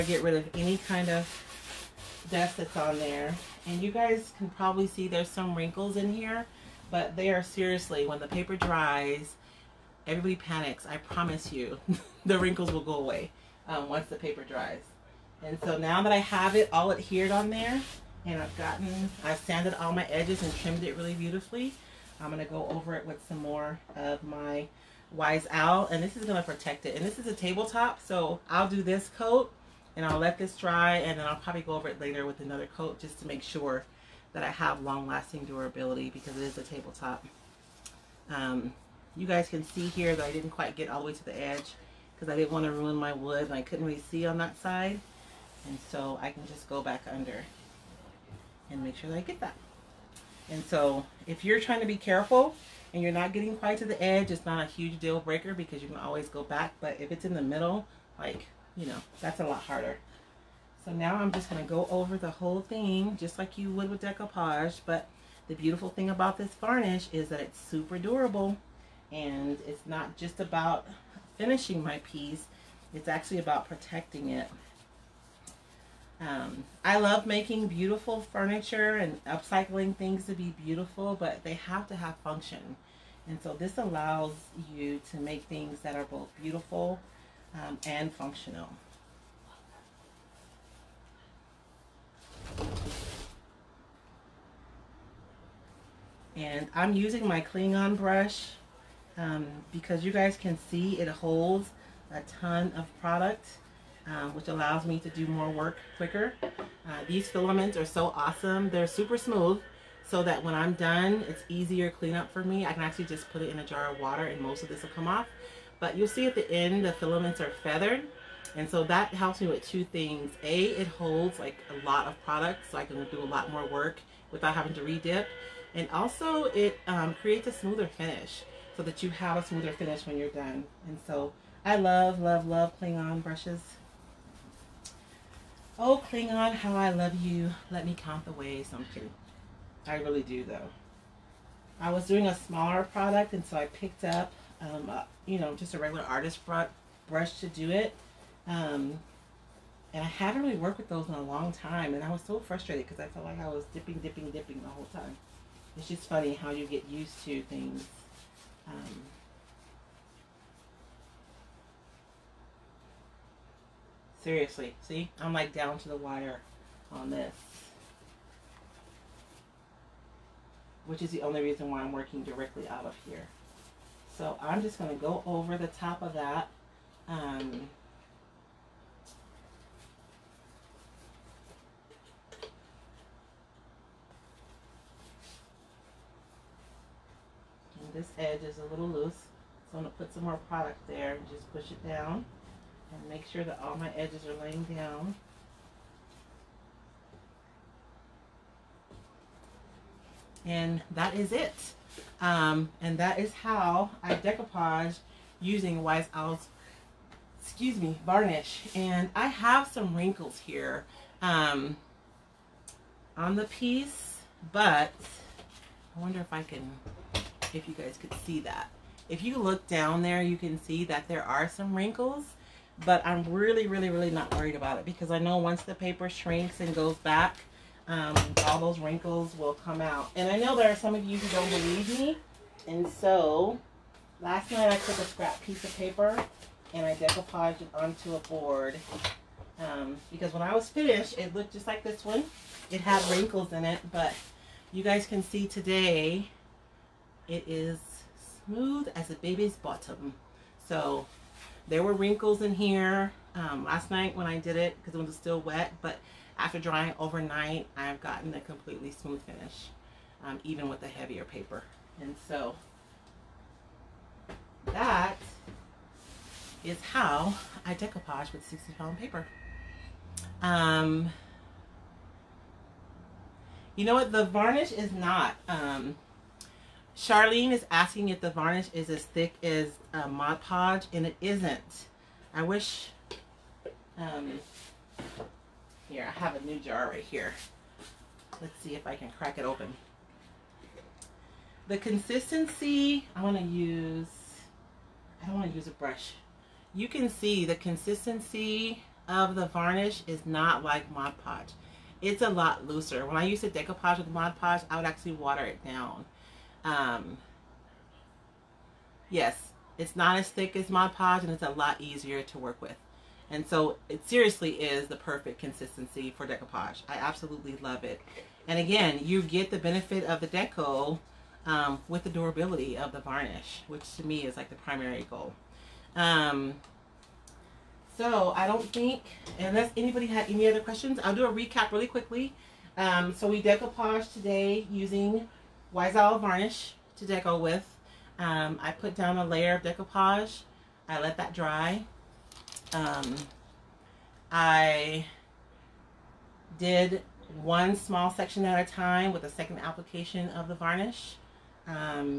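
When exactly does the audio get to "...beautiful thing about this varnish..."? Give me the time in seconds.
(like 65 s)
65 s.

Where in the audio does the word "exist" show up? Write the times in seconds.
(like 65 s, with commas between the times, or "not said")
not said.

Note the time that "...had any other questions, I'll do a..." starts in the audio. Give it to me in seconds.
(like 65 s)
330 s.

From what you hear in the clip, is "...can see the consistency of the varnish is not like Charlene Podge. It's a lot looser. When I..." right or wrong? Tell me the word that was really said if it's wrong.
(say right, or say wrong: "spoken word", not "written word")
wrong: "Mod", not "Charlene".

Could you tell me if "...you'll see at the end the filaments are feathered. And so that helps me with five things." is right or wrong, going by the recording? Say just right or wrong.
wrong.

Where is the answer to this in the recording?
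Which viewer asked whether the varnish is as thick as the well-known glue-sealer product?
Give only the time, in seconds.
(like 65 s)
276 s.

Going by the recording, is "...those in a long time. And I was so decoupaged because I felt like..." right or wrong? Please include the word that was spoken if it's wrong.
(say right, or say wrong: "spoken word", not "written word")
wrong: "frustrated", not "decoupaged".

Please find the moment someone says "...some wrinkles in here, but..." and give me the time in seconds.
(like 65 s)
5 s.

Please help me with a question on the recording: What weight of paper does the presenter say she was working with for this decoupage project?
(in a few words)
60 pound.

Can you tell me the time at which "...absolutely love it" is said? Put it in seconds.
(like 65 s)
316 s.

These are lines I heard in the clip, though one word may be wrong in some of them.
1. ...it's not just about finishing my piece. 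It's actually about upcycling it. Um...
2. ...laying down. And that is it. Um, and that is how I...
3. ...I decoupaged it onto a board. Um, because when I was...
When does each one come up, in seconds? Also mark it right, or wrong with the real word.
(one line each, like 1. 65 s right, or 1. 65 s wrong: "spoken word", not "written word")
1. 69 s wrong: "protecting", not "upcycling"
2. 194 s right
3. 236 s right.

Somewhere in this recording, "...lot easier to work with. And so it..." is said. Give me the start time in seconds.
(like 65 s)
311 s.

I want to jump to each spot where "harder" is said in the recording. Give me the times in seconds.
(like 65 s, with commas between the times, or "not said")
59 s.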